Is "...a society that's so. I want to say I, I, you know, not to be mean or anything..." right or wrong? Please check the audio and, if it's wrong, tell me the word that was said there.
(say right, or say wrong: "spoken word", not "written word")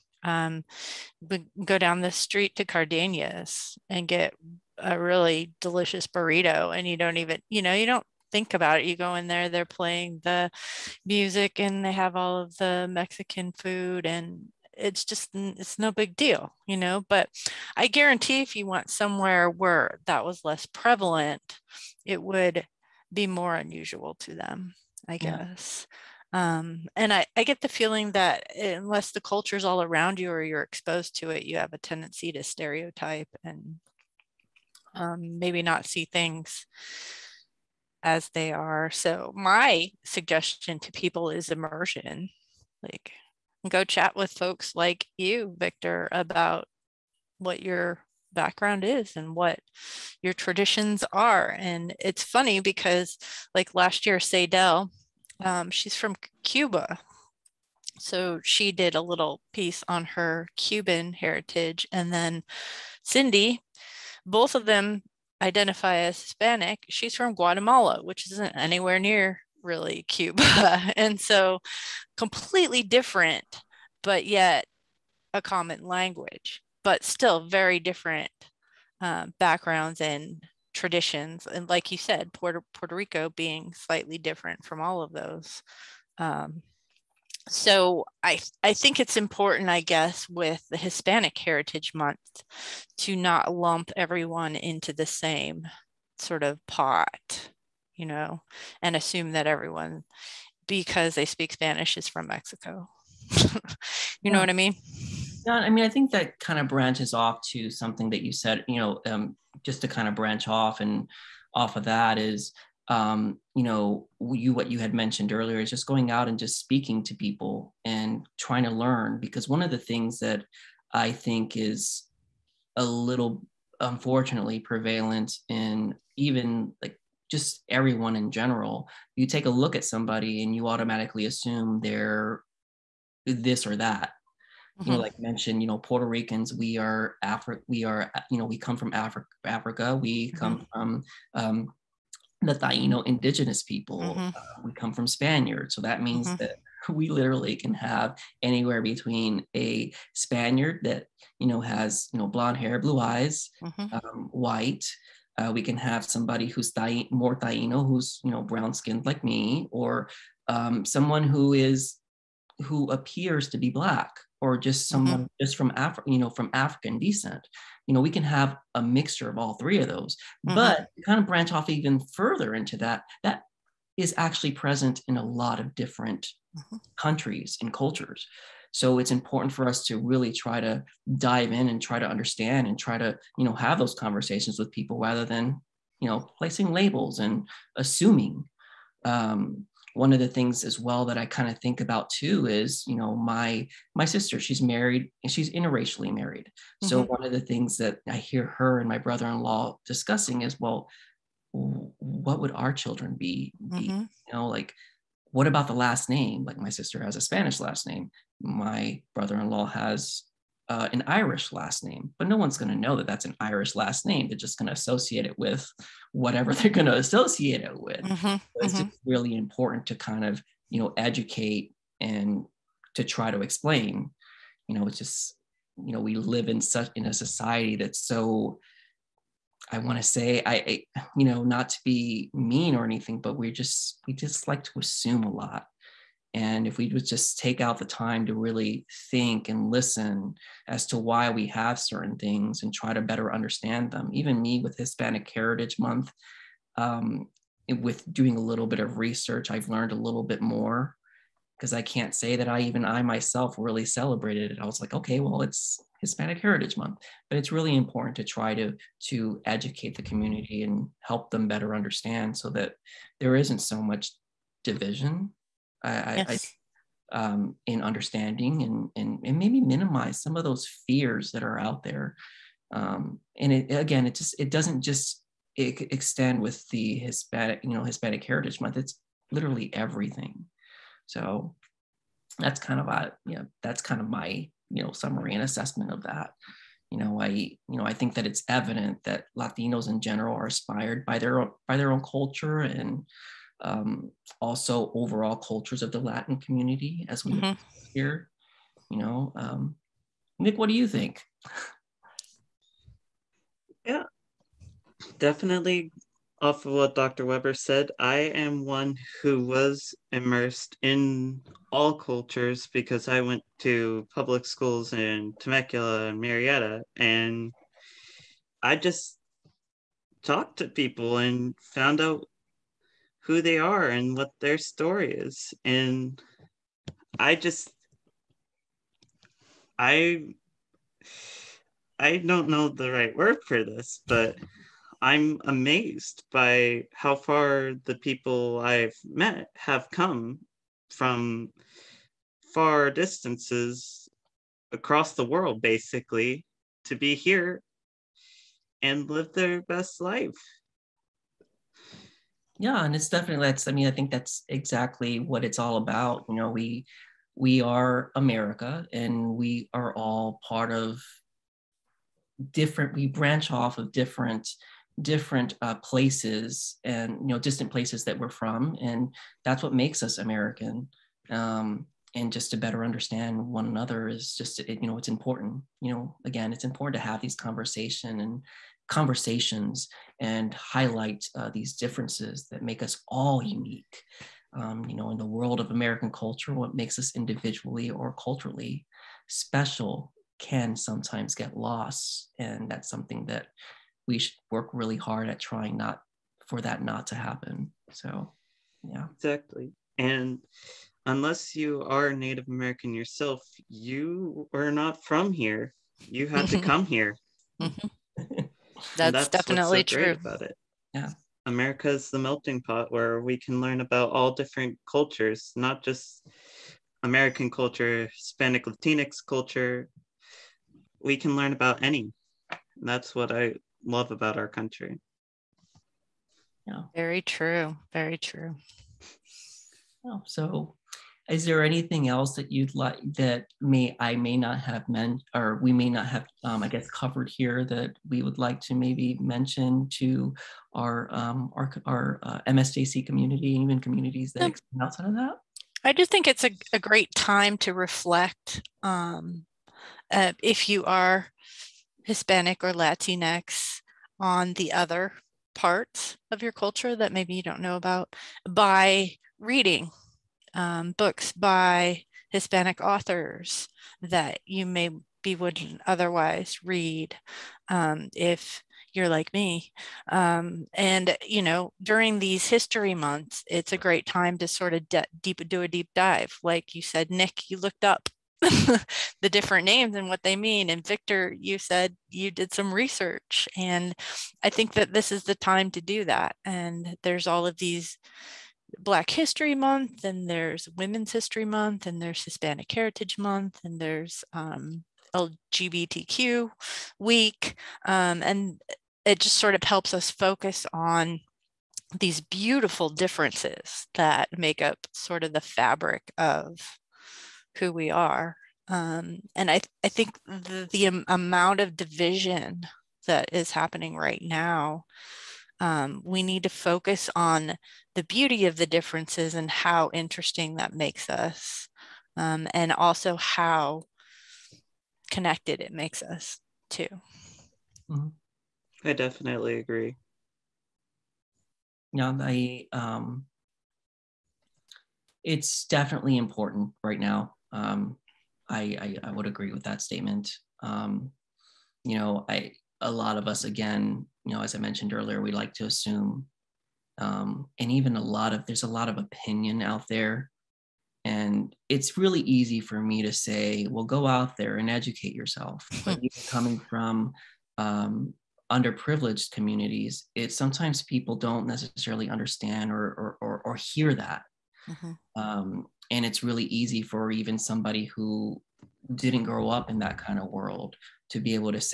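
right.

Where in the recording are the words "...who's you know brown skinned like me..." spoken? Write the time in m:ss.
2:37.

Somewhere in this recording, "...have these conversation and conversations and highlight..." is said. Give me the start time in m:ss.
6:17.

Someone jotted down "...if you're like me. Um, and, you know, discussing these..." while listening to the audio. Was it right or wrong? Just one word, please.
wrong.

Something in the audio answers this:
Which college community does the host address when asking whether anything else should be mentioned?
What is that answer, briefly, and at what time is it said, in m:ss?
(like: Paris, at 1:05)
MSJC, at 7:22.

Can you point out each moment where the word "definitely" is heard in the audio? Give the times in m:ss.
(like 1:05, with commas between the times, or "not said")
5:05, 5:53, 6:49, 8:48, 8:55.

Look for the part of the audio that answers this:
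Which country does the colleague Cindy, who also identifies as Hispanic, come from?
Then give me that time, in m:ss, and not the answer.
1:07.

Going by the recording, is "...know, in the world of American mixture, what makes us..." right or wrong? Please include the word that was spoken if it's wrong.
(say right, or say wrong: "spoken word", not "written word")
wrong: "culture", not "mixture".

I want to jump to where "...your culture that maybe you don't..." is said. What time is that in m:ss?
7:36.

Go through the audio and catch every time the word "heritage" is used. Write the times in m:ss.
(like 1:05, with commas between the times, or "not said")
1:01, 1:31, 4:05, 4:16, 4:38, 8:12.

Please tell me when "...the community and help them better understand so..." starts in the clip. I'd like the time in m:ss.
4:19.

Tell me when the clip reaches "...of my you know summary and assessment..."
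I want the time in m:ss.
4:43.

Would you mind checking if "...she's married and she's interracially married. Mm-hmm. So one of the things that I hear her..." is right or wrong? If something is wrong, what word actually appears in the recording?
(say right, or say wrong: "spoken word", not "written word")
right.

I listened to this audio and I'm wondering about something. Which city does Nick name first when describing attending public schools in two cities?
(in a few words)
Temecula.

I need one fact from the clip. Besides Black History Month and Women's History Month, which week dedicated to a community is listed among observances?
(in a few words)
LGBTQ Week.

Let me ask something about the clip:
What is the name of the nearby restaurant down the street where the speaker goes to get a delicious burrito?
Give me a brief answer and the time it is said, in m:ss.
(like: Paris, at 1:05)
Cardenas, at 0:02.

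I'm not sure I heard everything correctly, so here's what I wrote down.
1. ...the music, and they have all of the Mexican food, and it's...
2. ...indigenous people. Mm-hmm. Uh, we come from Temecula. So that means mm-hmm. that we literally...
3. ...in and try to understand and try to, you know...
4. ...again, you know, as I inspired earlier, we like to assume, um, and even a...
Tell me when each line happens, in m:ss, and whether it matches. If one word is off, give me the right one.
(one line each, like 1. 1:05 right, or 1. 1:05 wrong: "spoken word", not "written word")
1. 0:10 right
2. 2:23 wrong: "Spaniards", not "Temecula"
3. 3:01 right
4. 9:03 wrong: "mentioned", not "inspired".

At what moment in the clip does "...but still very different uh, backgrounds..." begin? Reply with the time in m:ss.
1:16.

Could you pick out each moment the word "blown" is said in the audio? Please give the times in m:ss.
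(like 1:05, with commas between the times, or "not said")
not said.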